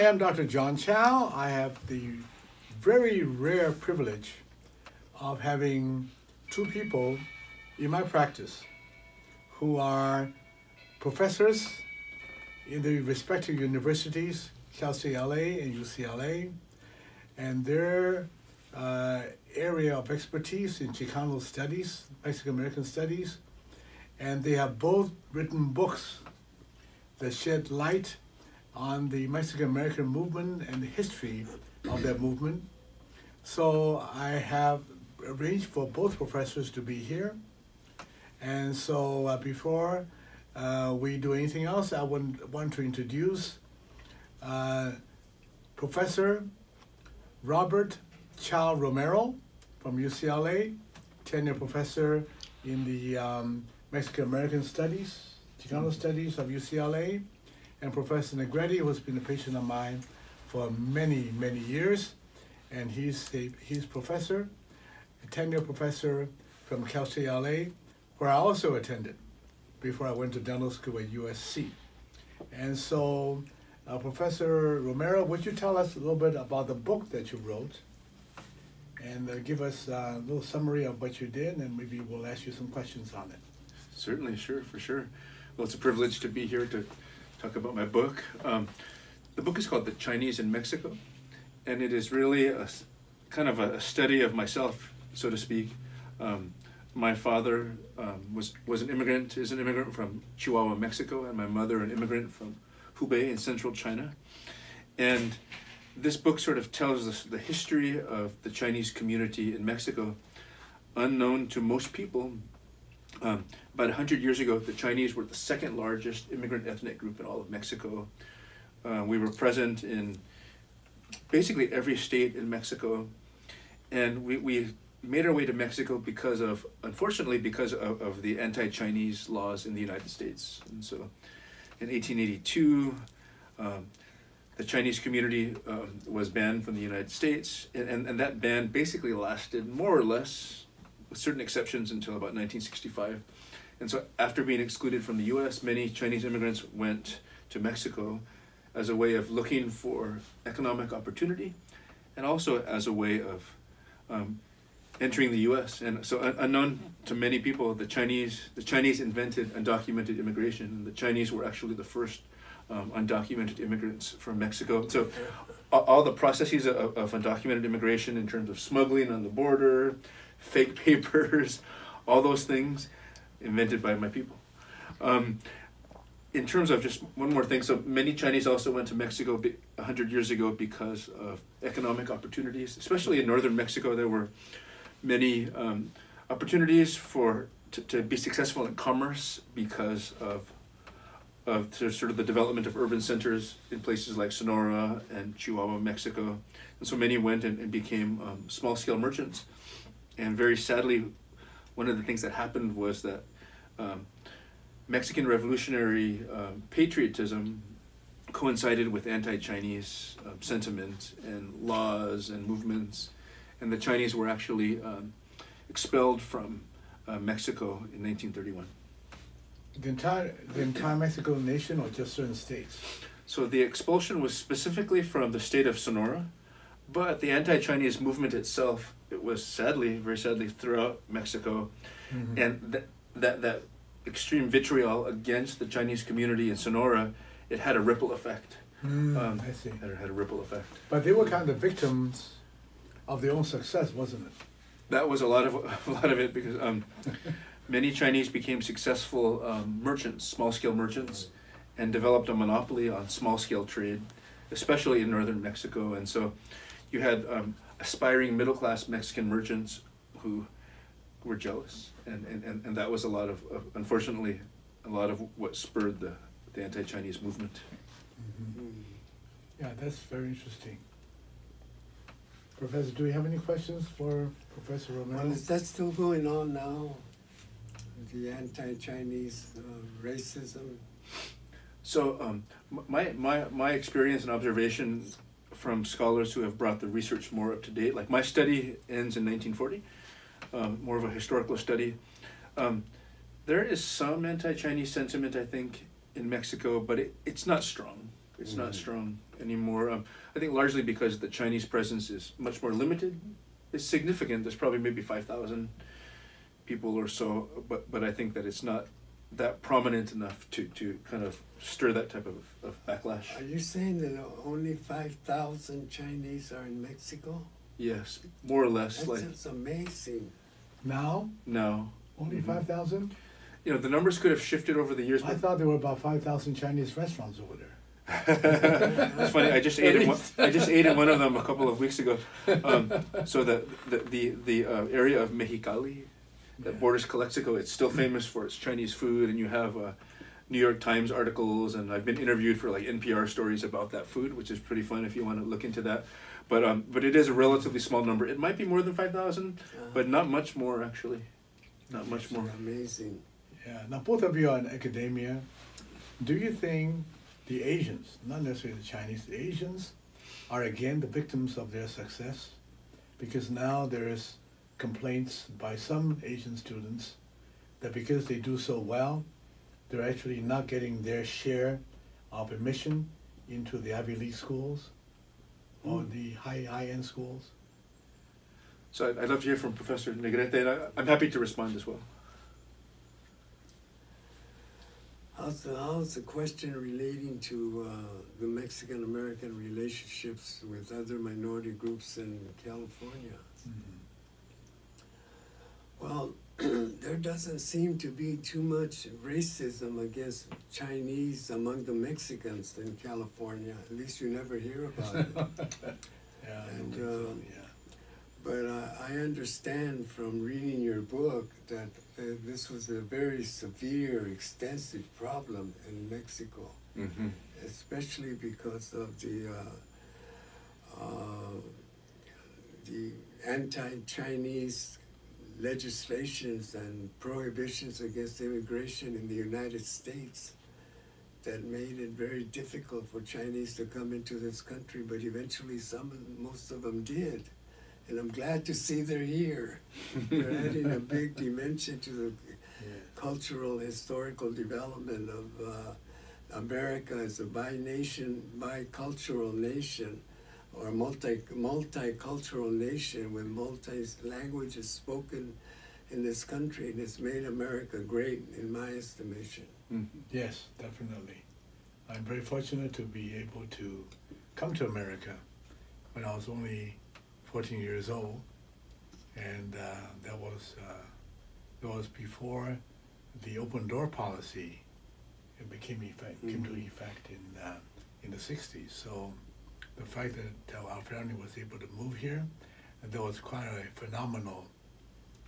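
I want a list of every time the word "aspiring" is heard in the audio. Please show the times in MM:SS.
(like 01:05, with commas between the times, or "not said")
04:17.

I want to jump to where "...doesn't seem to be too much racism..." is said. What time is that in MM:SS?
06:37.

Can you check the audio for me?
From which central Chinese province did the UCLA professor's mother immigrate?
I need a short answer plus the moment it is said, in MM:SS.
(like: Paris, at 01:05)
Hubei, at 01:42.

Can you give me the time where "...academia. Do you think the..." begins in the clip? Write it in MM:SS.
05:54.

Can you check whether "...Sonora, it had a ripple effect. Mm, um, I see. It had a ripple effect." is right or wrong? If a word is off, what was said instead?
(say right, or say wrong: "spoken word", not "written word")
right.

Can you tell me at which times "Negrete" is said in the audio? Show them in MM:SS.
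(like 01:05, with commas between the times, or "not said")
00:58, 06:20.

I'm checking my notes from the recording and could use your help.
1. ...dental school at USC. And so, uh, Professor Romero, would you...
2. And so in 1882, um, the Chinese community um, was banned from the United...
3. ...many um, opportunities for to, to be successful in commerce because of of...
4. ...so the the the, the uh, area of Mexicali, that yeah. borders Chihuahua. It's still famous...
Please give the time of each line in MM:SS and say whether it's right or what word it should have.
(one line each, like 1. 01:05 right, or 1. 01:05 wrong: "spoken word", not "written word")
1. 01:10 right
2. 02:10 right
3. 03:05 right
4. 05:33 wrong: "Calexico", not "Chihuahua".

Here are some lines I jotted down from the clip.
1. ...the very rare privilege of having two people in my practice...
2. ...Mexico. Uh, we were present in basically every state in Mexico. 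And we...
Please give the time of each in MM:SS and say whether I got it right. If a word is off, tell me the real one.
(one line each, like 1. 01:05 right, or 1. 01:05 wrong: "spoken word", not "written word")
1. 00:01 right
2. 01:57 right.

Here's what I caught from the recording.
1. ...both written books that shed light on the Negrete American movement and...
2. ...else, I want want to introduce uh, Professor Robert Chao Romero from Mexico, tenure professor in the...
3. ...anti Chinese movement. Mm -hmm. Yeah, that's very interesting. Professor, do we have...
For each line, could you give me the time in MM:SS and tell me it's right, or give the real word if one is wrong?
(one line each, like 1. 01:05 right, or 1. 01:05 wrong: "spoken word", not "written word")
1. 00:24 wrong: "Mexican", not "Negrete"
2. 00:41 wrong: "UCLA", not "Mexico"
3. 04:26 right.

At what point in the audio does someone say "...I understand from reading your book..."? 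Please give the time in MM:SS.
06:49.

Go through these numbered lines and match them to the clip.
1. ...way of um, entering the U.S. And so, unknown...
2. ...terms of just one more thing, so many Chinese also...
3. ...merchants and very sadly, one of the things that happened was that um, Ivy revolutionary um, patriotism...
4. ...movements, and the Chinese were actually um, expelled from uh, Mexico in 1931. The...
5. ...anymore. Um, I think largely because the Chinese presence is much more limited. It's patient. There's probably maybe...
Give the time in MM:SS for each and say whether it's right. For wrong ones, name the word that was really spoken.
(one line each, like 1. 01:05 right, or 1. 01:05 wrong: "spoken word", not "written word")
1. 02:32 right
2. 02:56 right
3. 03:18 wrong: "Mexican", not "Ivy"
4. 03:32 right
5. 04:59 wrong: "significant", not "patient".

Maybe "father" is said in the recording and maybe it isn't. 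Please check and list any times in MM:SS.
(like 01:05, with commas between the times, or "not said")
01:37.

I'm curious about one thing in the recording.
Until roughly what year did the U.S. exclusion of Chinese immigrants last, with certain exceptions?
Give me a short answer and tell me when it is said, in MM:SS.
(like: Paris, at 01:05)
1965, at 02:22.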